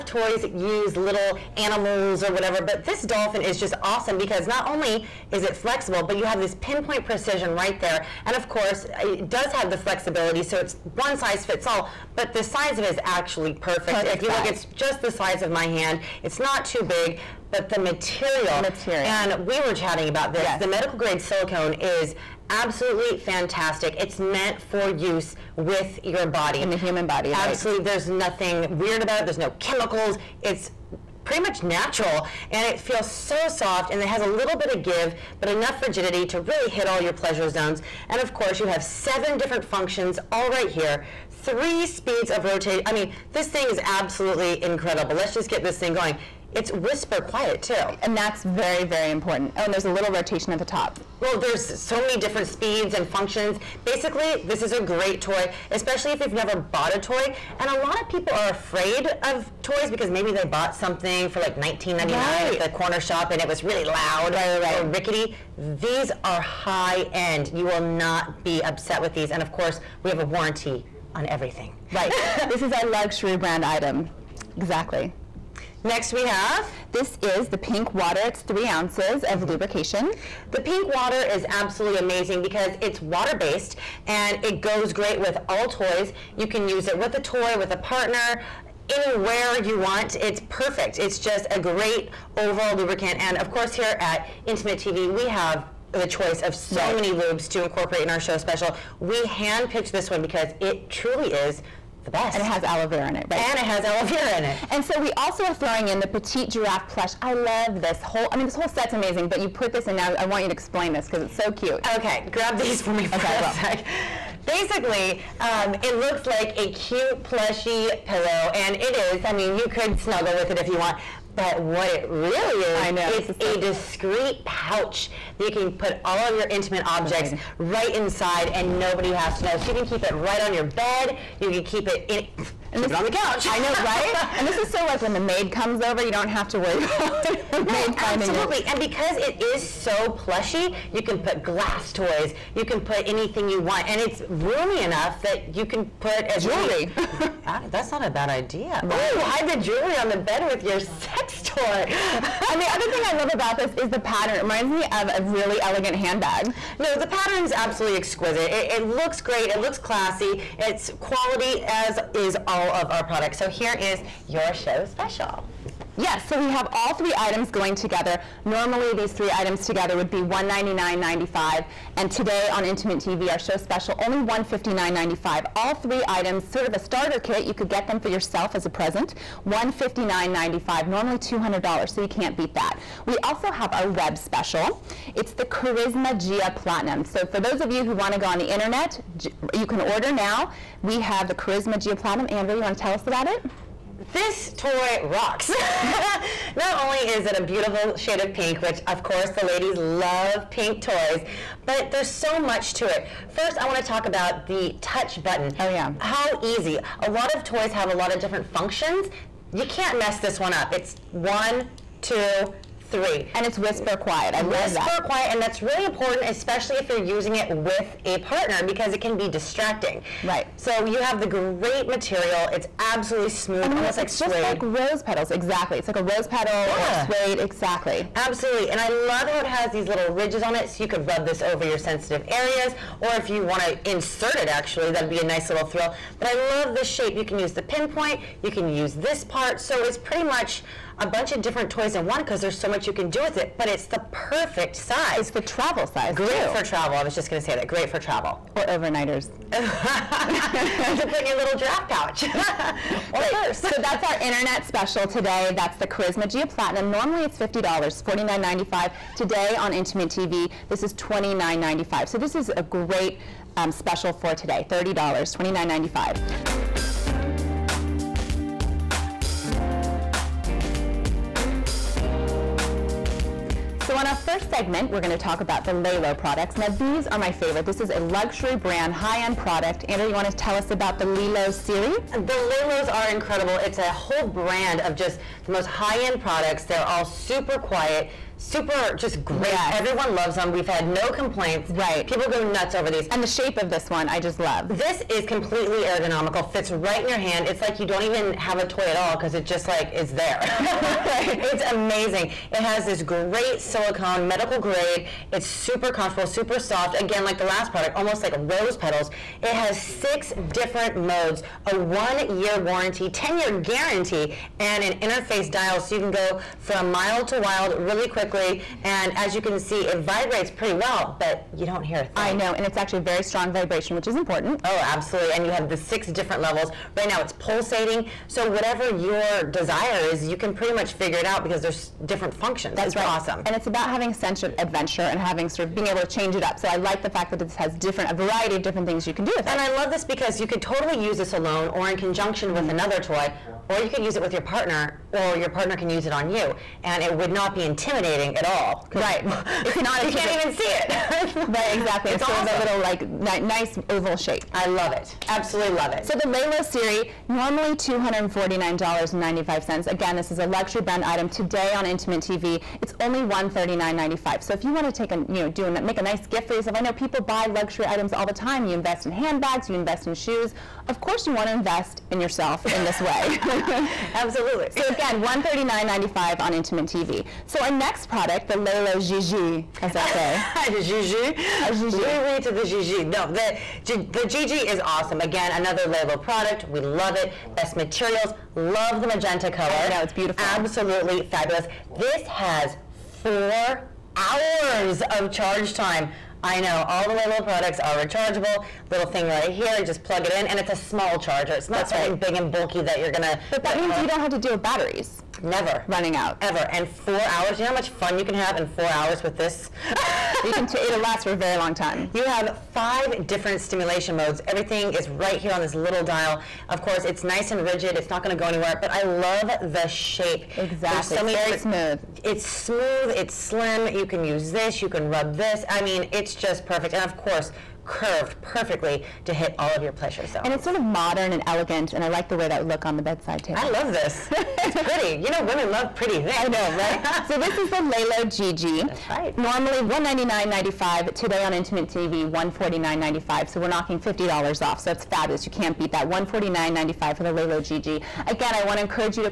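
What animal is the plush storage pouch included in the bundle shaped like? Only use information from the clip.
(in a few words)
giraffe.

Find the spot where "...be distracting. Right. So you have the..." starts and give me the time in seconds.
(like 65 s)
219 s.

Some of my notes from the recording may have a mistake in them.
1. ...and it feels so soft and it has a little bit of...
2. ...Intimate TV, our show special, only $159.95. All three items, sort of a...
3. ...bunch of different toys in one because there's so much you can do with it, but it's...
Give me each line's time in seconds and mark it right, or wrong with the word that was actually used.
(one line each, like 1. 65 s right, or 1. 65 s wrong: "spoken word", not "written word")
1. 32 s right
2. 172 s right
3. 241 s right.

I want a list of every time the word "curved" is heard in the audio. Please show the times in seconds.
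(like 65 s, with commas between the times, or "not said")
427 s.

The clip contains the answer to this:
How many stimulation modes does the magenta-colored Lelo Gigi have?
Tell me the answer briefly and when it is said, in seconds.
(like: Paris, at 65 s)
5, at 412 s.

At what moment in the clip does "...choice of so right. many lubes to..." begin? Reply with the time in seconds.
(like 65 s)
96 s.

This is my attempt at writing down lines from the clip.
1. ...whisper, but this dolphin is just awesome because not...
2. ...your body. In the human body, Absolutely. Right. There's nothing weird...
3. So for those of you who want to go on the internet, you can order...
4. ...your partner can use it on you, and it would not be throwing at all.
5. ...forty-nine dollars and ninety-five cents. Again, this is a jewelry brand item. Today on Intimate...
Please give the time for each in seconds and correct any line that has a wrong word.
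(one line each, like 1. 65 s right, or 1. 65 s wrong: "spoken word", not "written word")
1. 2 s wrong: "whatever", not "whisper"
2. 26 s right
3. 187 s right
4. 345 s wrong: "intimidating", not "throwing"
5. 358 s wrong: "luxury", not "jewelry".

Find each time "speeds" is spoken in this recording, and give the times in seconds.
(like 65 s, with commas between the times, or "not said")
41 s, 52 s.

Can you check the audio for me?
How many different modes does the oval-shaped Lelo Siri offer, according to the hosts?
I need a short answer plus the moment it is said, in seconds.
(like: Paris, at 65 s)
6, at 309 s.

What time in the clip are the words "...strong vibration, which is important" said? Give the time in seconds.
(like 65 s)
323 s.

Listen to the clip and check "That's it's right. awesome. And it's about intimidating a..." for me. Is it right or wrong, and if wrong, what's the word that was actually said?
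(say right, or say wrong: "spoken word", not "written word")
wrong: "having", not "intimidating".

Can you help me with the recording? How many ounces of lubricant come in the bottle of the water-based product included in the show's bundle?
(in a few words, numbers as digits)
3.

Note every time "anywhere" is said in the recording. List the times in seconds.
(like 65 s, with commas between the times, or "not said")
88 s, 418 s.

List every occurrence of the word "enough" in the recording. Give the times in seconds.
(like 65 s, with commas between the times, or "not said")
35 s, 144 s.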